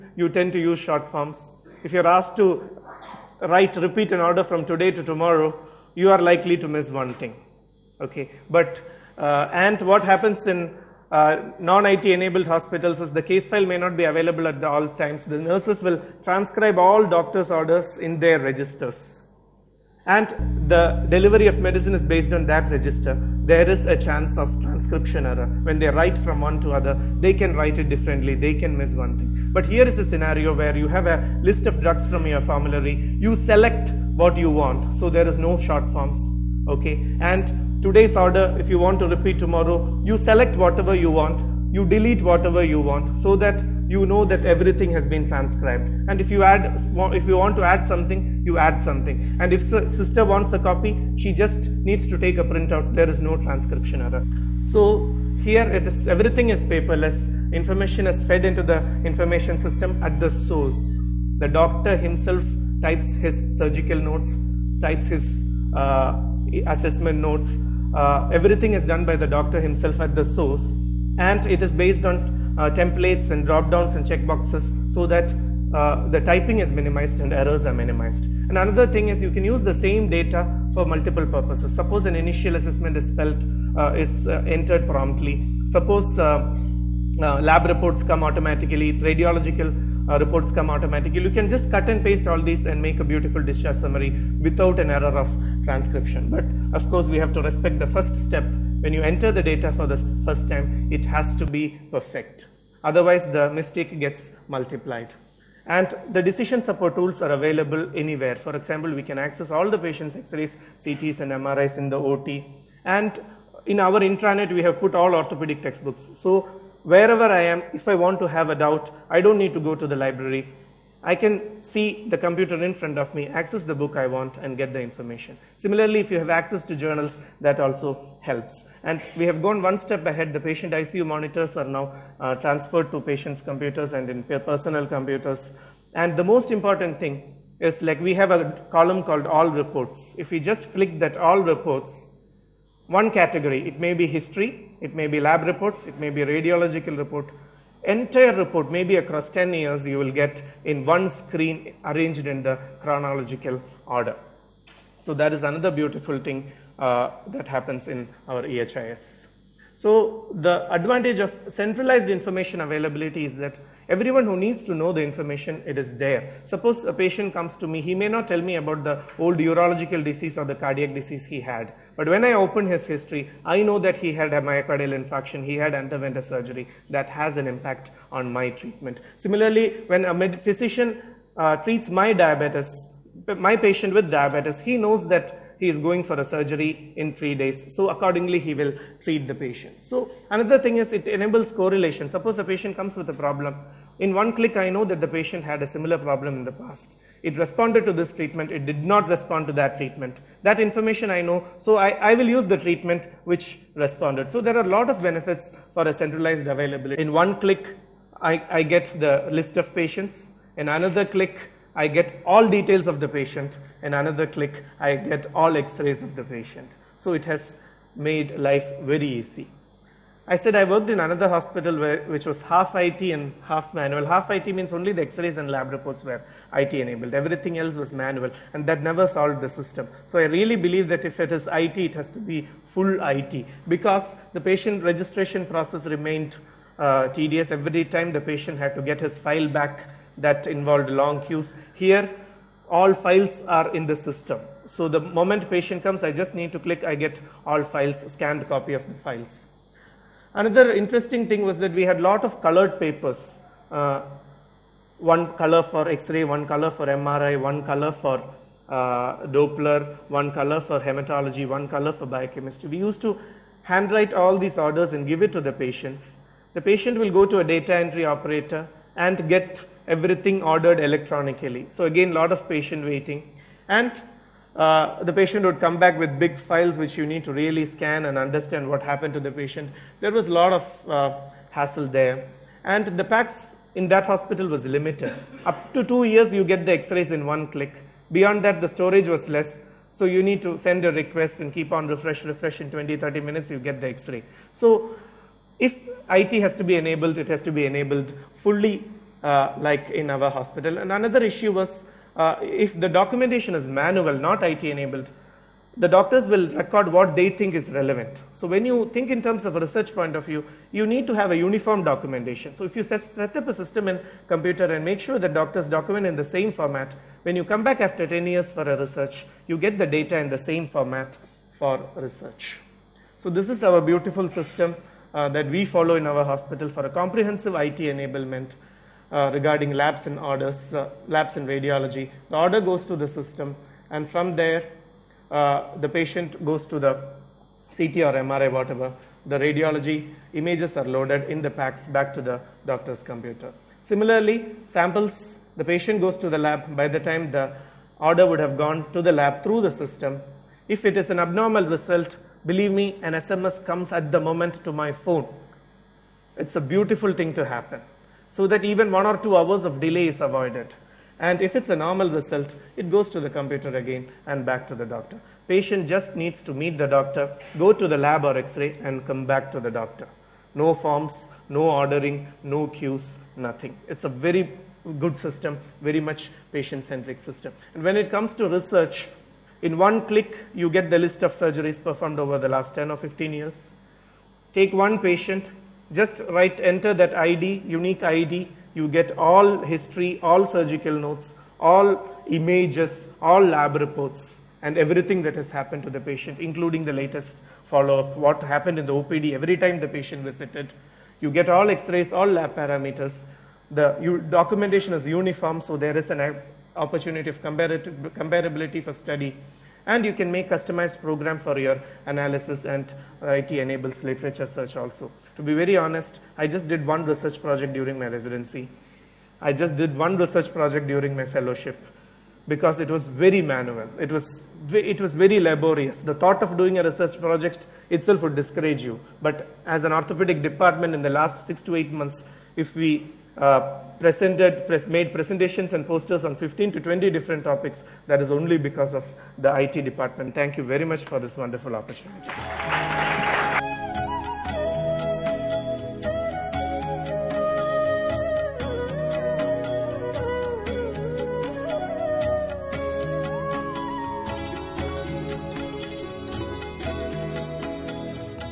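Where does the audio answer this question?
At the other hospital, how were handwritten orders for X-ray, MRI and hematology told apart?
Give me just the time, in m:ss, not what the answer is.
4:12.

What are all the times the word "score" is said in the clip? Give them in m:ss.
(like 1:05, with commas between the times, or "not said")
not said.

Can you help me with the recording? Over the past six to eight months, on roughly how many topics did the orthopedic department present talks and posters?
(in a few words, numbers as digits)
15 to 20.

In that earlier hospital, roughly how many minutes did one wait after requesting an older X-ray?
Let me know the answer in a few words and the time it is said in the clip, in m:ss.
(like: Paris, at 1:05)
20, 30 minutes, at 4:52.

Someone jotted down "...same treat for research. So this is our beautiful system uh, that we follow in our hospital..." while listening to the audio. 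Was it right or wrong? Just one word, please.
wrong.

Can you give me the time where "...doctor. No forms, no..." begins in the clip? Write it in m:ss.
6:09.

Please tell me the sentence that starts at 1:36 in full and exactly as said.
But of course, we have to respect the first step.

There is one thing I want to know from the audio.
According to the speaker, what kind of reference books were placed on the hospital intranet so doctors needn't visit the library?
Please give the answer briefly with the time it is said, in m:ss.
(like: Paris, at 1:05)
orthopedic textbooks, at 1:55.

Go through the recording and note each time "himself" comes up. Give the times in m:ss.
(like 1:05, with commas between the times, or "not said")
1:01, 1:09.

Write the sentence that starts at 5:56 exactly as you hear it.
It's a beautiful thing to happen so that even one or two hours of delay is avoided.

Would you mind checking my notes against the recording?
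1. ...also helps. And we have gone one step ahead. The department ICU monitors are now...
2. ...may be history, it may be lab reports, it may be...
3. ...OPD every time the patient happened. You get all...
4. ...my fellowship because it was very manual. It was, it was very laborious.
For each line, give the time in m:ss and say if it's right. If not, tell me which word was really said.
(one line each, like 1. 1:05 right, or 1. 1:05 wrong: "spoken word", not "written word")
1. 2:07 wrong: "patient", not "department"
2. 2:23 right
3. 6:38 wrong: "visited", not "happened"
4. 7:01 right.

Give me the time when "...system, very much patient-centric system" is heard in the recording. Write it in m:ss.
6:15.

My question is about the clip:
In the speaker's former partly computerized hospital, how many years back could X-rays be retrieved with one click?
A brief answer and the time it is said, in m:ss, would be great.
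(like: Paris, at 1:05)
2 years, at 4:45.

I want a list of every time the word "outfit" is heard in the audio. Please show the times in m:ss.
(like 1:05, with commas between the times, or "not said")
not said.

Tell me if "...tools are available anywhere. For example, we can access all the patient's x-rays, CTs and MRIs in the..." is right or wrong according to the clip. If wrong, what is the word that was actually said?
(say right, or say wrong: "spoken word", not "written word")
right.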